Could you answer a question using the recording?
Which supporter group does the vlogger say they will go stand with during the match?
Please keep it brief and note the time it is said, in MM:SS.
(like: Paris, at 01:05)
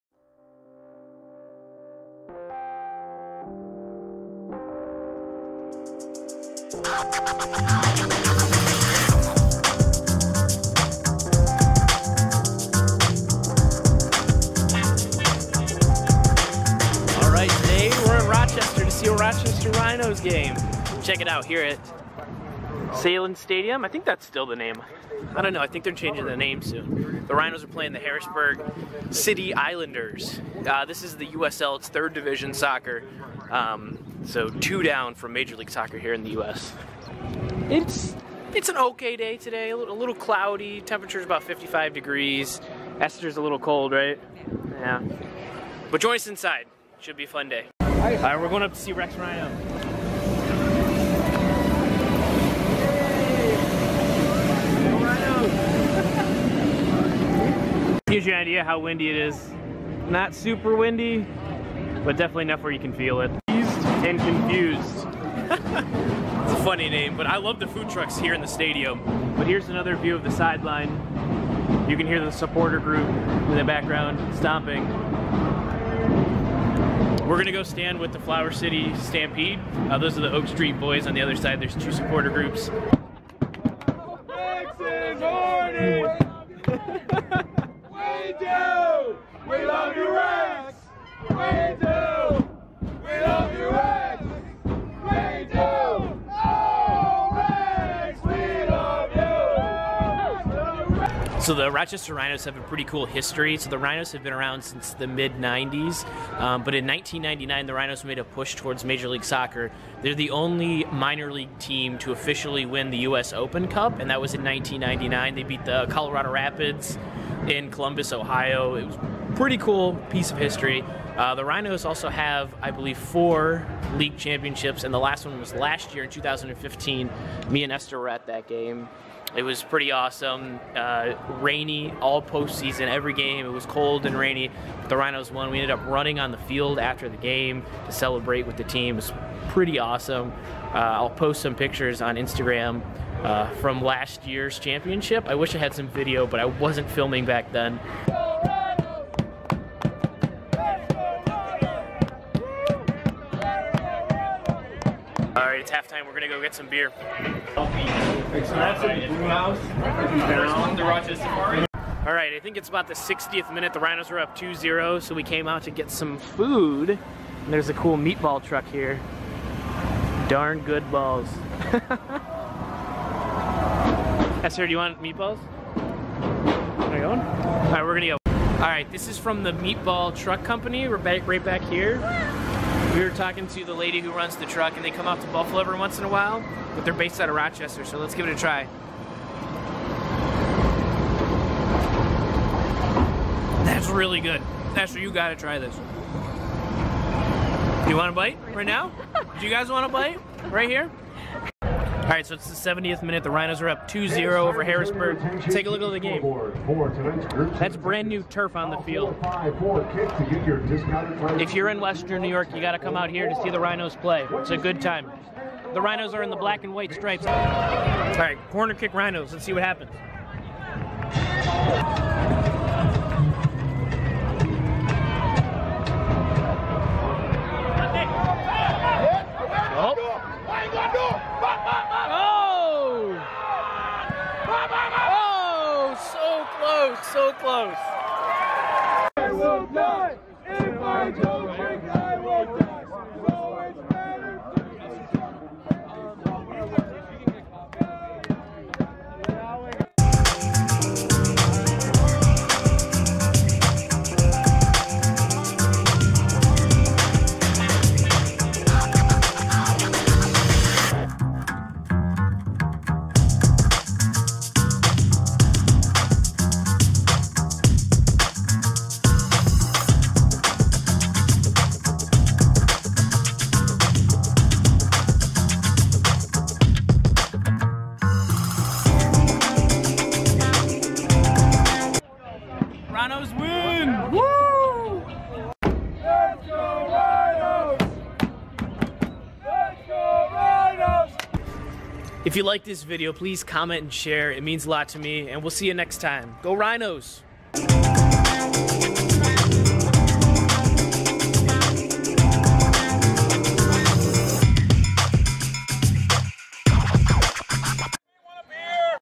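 Flower City Stampede, at 01:18.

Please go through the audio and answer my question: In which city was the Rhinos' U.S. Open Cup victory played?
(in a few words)
Columbus, Ohio.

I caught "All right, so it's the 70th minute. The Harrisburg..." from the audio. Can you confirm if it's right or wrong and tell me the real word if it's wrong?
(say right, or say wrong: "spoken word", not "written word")
wrong: "Rhinos", not "Harrisburg".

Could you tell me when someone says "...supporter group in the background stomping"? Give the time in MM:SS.
01:12.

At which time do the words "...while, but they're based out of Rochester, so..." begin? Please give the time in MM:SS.
03:06.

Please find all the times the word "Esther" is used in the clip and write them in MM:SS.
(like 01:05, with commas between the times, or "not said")
00:42, 02:07, 02:54.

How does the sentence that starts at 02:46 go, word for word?
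And there's a cool meatball truck here.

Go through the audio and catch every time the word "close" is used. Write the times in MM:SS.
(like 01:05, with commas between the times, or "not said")
03:57.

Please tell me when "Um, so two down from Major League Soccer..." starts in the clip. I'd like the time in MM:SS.
00:33.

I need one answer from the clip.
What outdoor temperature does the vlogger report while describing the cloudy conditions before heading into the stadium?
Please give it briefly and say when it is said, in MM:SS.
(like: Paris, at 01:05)
55 degrees, at 00:41.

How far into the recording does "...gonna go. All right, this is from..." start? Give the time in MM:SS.
02:57.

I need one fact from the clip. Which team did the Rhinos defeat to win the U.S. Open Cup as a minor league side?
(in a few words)
Colorado Rapids.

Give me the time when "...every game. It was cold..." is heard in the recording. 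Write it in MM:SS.
02:12.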